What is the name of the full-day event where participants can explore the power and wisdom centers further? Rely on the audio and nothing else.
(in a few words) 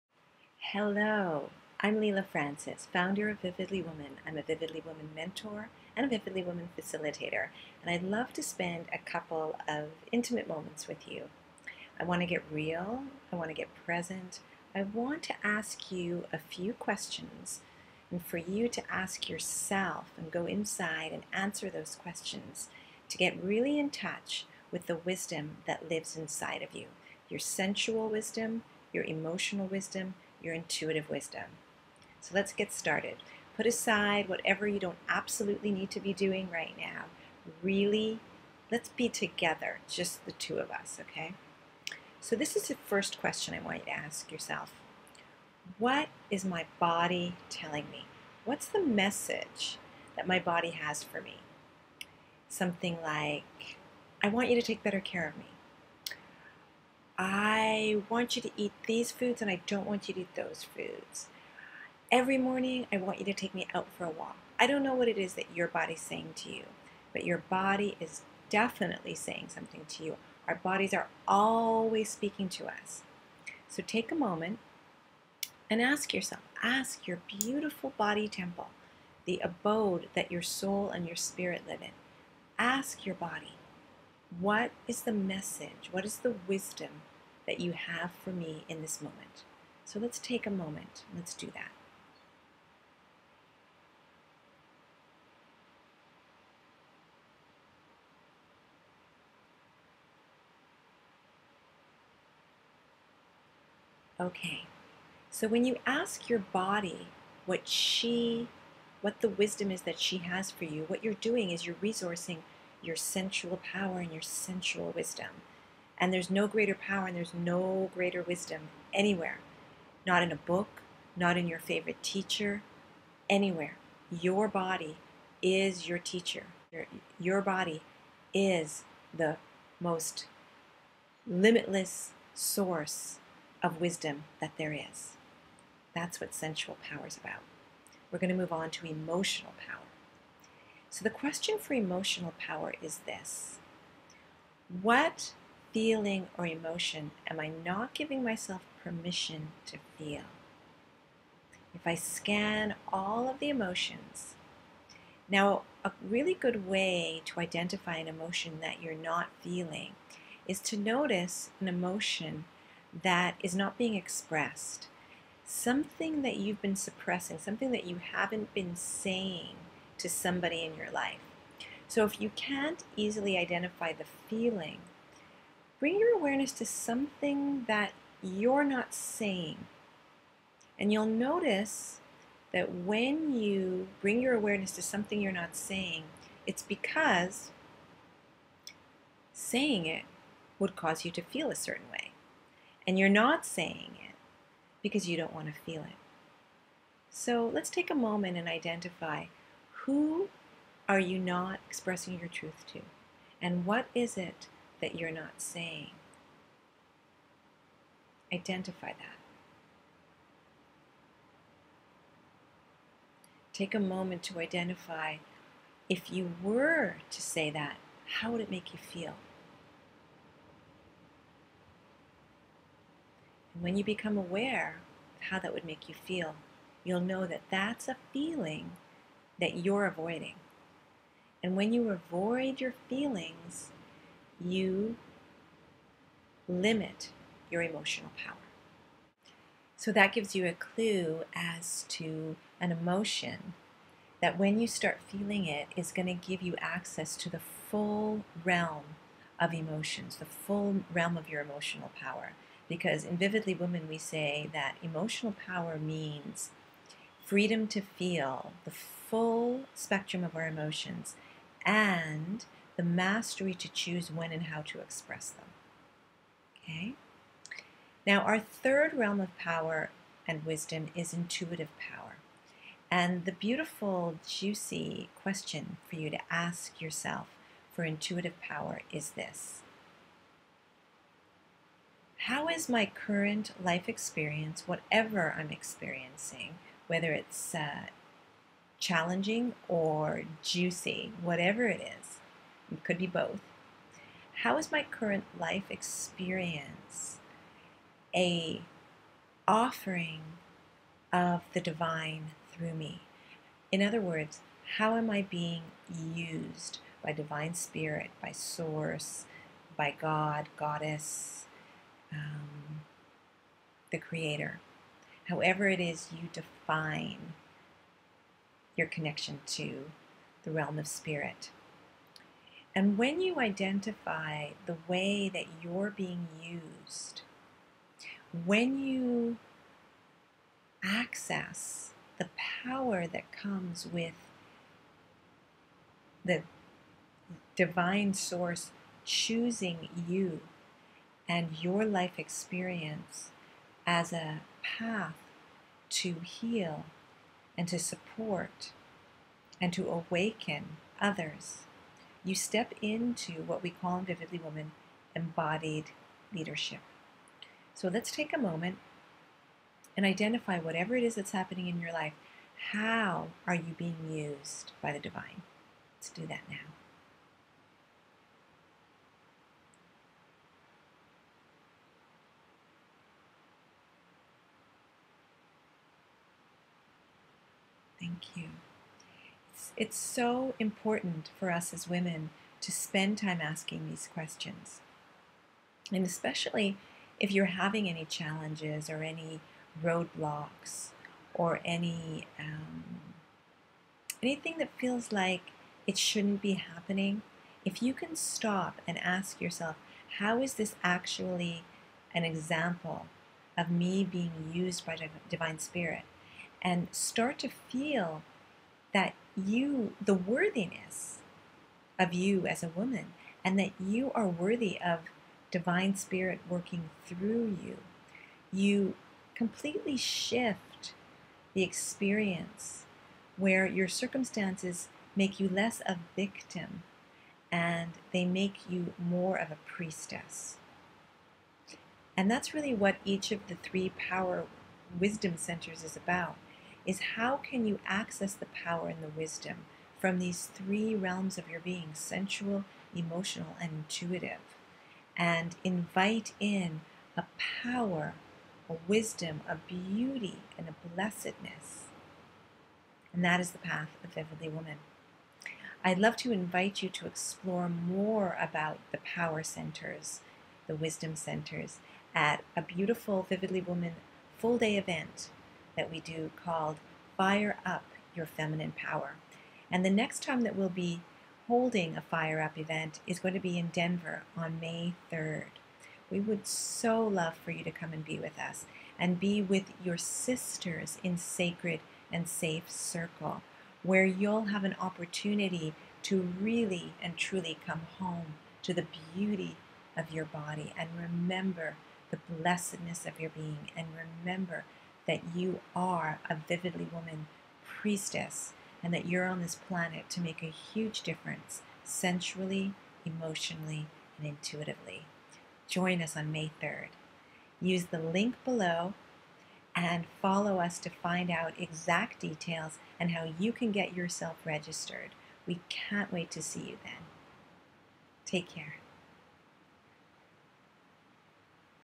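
Fire Up Your Feminine Power.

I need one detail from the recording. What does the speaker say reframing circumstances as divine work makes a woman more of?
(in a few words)
a priestess.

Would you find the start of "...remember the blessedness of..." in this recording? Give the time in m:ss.
8:11.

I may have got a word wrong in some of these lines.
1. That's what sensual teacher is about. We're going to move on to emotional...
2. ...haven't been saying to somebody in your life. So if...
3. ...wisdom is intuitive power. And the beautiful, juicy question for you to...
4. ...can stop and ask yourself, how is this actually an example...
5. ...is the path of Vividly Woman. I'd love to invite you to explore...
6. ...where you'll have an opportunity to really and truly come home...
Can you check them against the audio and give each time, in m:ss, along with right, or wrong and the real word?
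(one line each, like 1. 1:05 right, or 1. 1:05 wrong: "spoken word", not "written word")
1. 2:15 wrong: "power", not "teacher"
2. 2:48 right
3. 4:30 right
4. 6:37 right
5. 7:33 right
6. 8:03 right.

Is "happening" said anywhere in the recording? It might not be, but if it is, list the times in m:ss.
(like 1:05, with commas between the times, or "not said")
6:01, 6:36.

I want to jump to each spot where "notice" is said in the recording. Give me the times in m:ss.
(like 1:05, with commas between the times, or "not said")
2:40, 3:01.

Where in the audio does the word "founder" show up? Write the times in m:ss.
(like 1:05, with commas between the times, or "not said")
0:02.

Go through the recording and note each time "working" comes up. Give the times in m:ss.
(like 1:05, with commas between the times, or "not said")
6:56.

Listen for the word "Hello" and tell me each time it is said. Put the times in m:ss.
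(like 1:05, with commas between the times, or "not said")
0:00.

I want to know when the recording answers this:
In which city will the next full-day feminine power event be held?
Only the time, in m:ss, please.
7:53.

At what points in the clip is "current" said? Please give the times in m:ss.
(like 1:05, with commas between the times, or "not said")
4:42, 4:54.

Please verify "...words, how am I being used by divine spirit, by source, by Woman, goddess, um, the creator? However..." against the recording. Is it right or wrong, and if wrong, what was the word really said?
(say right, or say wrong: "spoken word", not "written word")
wrong: "God", not "Woman".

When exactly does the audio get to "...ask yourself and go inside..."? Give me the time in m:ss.
0:18.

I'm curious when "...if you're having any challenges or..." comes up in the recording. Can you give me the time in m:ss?
6:27.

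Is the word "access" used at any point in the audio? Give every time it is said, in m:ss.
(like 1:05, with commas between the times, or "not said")
4:06, 5:30, 7:17.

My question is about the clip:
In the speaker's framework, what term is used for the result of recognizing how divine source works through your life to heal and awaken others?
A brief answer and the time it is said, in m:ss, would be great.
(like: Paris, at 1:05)
embodied leadership, at 5:55.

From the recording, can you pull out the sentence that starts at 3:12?
And you're not saying it because you don't want to feel it.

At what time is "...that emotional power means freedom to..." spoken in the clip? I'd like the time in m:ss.
4:14.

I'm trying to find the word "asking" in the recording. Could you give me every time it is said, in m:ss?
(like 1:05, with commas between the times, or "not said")
6:23.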